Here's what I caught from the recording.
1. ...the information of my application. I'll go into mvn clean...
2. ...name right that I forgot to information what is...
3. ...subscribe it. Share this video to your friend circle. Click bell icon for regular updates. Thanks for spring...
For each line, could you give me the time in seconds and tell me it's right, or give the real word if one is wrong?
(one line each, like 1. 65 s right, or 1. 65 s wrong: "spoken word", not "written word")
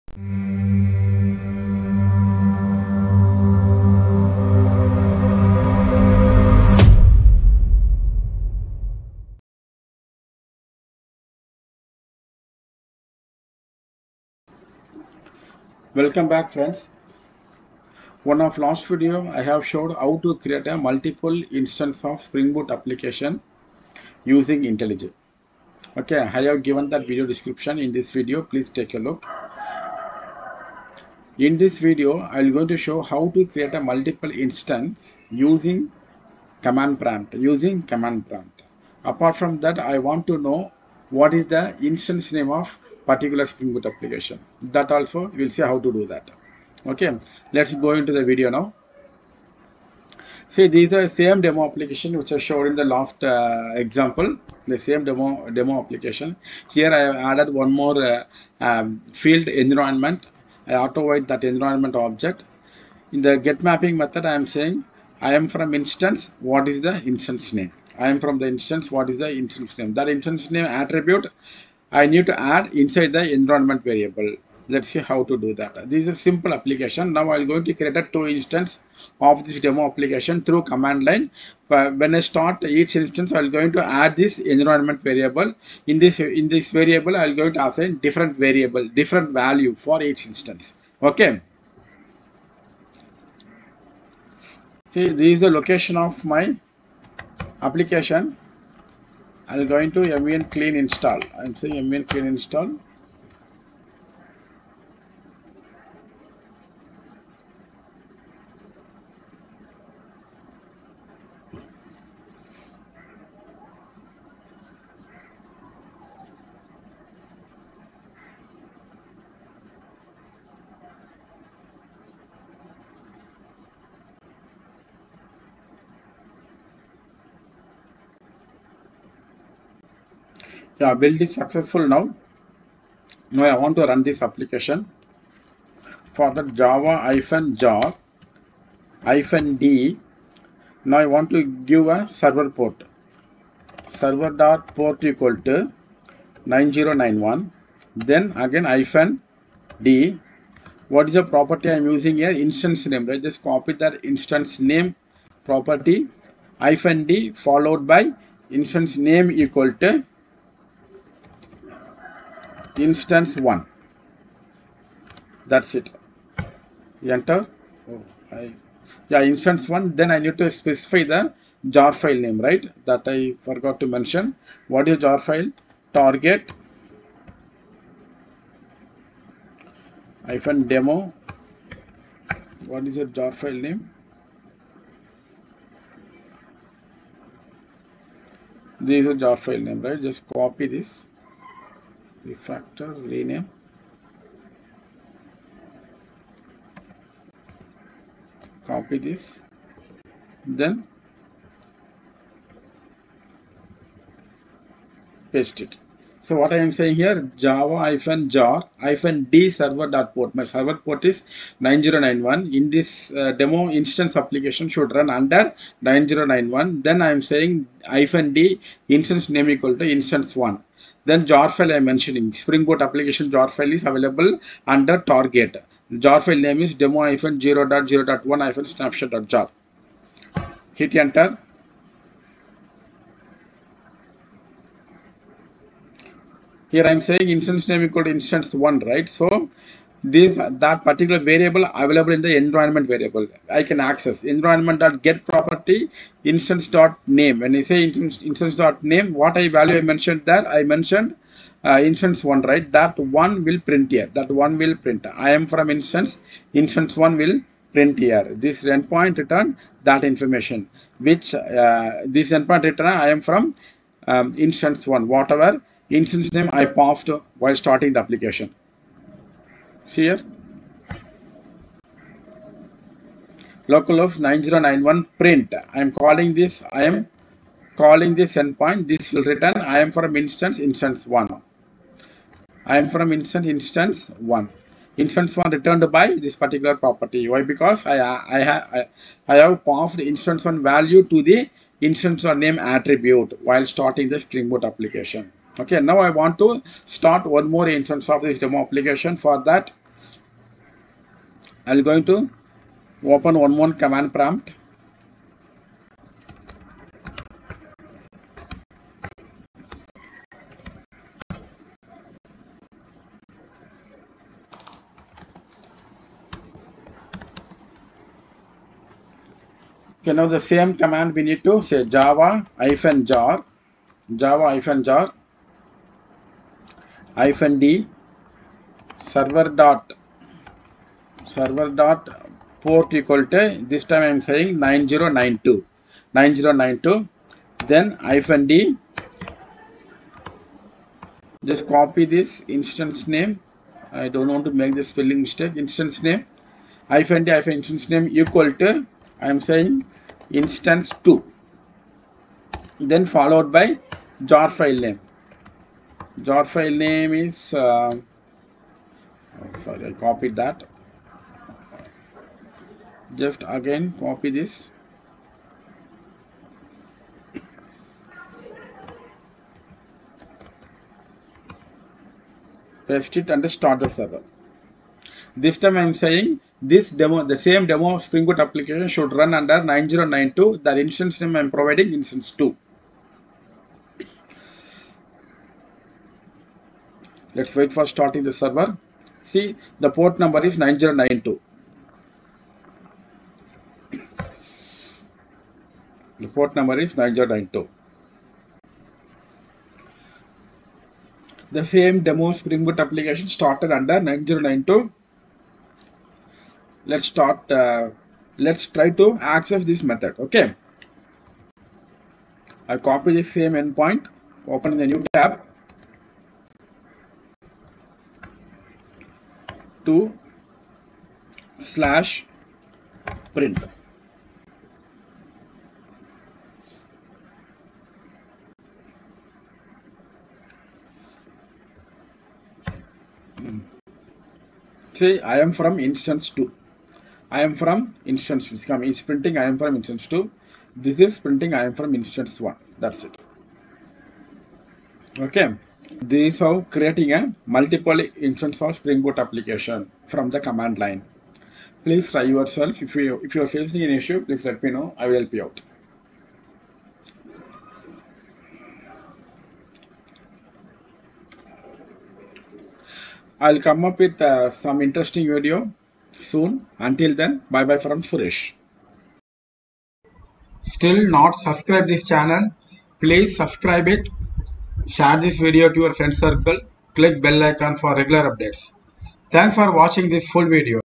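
1. 95 s wrong: "location", not "information"
2. 172 s wrong: "mention", not "information"
3. 473 s wrong: "watching", not "spring".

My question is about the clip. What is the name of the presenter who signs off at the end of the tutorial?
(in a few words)
Suresh.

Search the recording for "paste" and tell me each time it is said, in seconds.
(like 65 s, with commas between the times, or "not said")
205 s, 372 s.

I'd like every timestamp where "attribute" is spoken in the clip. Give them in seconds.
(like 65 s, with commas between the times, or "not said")
70 s, 292 s.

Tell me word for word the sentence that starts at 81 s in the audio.
When I start each instance, I'm going to add this environment variable.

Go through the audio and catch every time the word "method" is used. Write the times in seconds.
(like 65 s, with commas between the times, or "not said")
63 s, 409 s.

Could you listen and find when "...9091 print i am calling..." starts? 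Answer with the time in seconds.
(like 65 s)
274 s.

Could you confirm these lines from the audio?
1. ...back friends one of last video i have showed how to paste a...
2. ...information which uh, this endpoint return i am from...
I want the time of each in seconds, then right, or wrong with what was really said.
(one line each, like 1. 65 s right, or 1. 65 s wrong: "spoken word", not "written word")
1. 16 s wrong: "create", not "paste"
2. 260 s right.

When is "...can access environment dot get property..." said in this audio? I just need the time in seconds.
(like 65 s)
243 s.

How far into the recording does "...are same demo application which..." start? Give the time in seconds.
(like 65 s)
50 s.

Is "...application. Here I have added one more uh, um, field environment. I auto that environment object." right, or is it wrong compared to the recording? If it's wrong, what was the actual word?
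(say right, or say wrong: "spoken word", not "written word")
right.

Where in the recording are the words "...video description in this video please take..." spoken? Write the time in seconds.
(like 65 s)
27 s.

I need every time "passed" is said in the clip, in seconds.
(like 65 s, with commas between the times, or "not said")
266 s, 289 s.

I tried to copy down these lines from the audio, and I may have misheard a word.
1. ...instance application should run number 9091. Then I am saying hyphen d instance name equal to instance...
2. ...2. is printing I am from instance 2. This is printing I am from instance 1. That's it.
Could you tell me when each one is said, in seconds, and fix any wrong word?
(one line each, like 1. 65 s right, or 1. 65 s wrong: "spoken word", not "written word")
1. 213 s wrong: "under", not "number"
2. 438 s right.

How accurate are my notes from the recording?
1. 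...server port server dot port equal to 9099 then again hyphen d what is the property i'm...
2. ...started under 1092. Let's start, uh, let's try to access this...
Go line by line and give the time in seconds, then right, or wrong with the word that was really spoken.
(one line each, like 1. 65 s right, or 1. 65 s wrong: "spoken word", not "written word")
1. 142 s wrong: "9091", not "9099"
2. 403 s wrong: "9092", not "1092".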